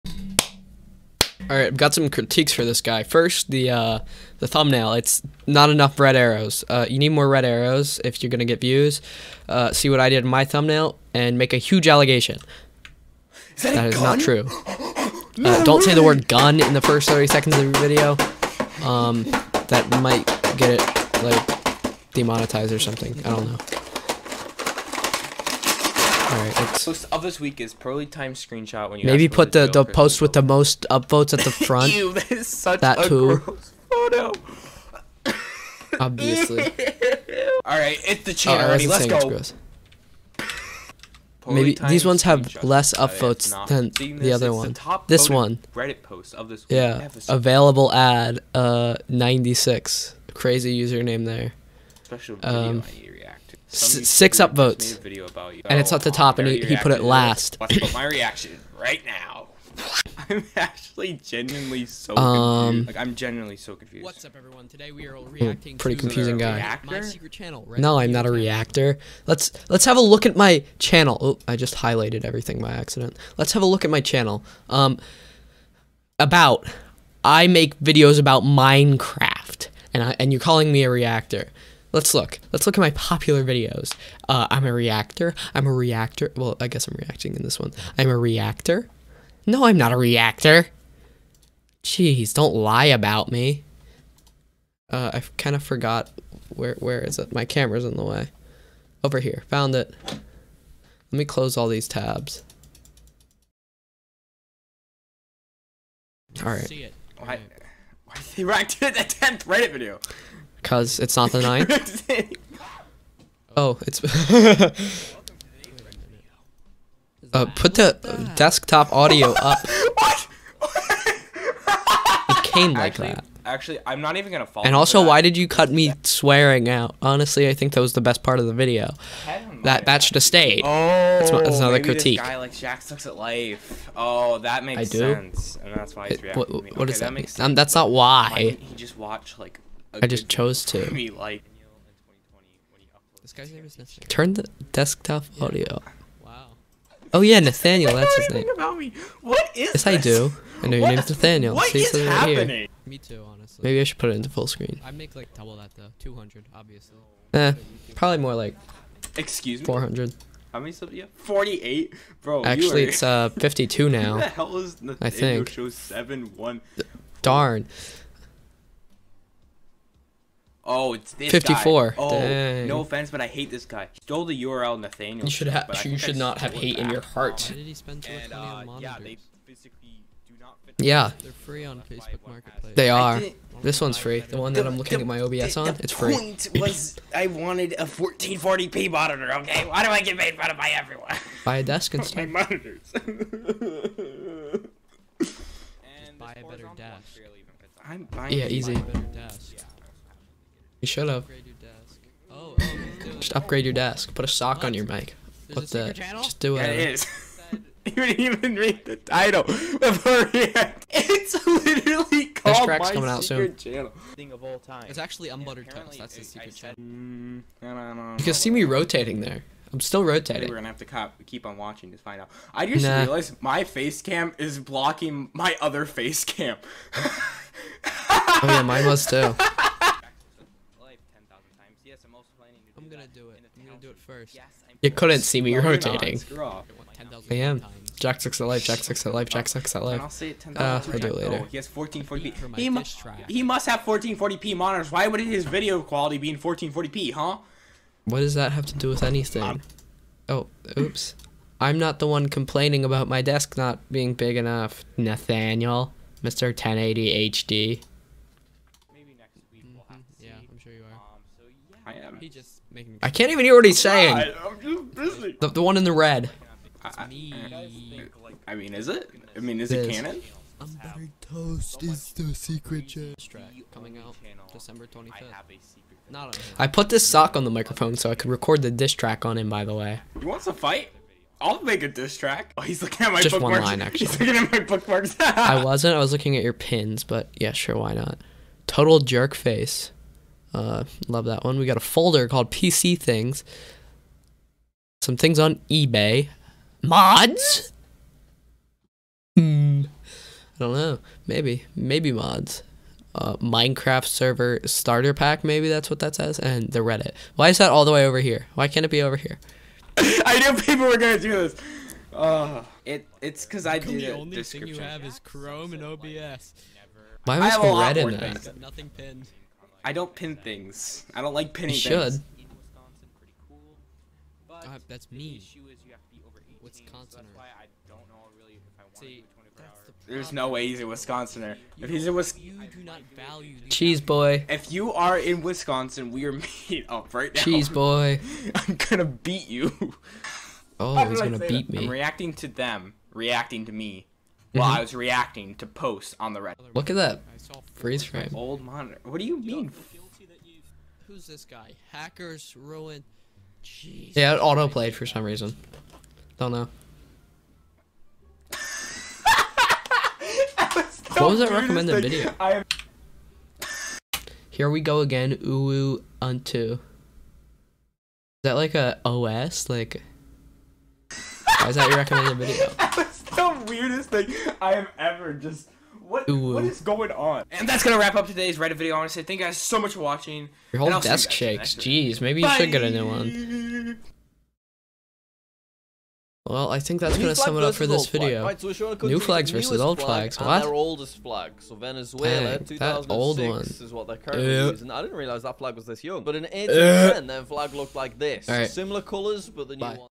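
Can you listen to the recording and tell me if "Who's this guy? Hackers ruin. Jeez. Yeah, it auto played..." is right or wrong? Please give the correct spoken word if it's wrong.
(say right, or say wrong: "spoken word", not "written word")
right.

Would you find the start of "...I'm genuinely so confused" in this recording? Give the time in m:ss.
1:03.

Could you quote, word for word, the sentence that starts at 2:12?
This guy like Jack sucks at life.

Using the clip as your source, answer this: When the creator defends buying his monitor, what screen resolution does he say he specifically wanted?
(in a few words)
1440p.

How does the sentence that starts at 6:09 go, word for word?
Like, why is that your recommended video?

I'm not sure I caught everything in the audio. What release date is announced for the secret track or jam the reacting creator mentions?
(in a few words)
December 25th.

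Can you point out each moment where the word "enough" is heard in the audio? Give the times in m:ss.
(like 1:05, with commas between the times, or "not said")
0:05, 4:14.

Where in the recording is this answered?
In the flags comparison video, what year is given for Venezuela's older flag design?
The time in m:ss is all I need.
6:36.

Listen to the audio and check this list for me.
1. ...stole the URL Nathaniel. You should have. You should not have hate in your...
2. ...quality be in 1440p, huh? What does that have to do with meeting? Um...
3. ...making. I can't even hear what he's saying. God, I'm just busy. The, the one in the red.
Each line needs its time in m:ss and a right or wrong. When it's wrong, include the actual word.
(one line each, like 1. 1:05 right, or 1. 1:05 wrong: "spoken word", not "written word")
1. 2:54 right
2. 4:05 wrong: "anything", not "meeting"
3. 4:22 right.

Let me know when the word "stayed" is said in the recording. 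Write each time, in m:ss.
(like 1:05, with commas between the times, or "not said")
2:10.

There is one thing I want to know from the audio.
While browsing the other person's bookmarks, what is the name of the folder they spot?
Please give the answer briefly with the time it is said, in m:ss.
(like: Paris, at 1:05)
PC Things, at 4:52.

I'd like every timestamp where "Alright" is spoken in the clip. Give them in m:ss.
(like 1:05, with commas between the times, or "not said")
0:26, 0:36.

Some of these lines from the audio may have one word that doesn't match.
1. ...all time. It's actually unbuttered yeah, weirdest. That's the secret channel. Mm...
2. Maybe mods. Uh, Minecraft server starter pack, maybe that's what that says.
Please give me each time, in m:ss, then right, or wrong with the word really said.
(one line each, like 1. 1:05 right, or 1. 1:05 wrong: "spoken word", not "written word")
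1. 3:34 wrong: "toast", not "weirdest"
2. 5:01 right.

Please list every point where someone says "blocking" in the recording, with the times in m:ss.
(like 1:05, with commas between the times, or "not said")
3:44.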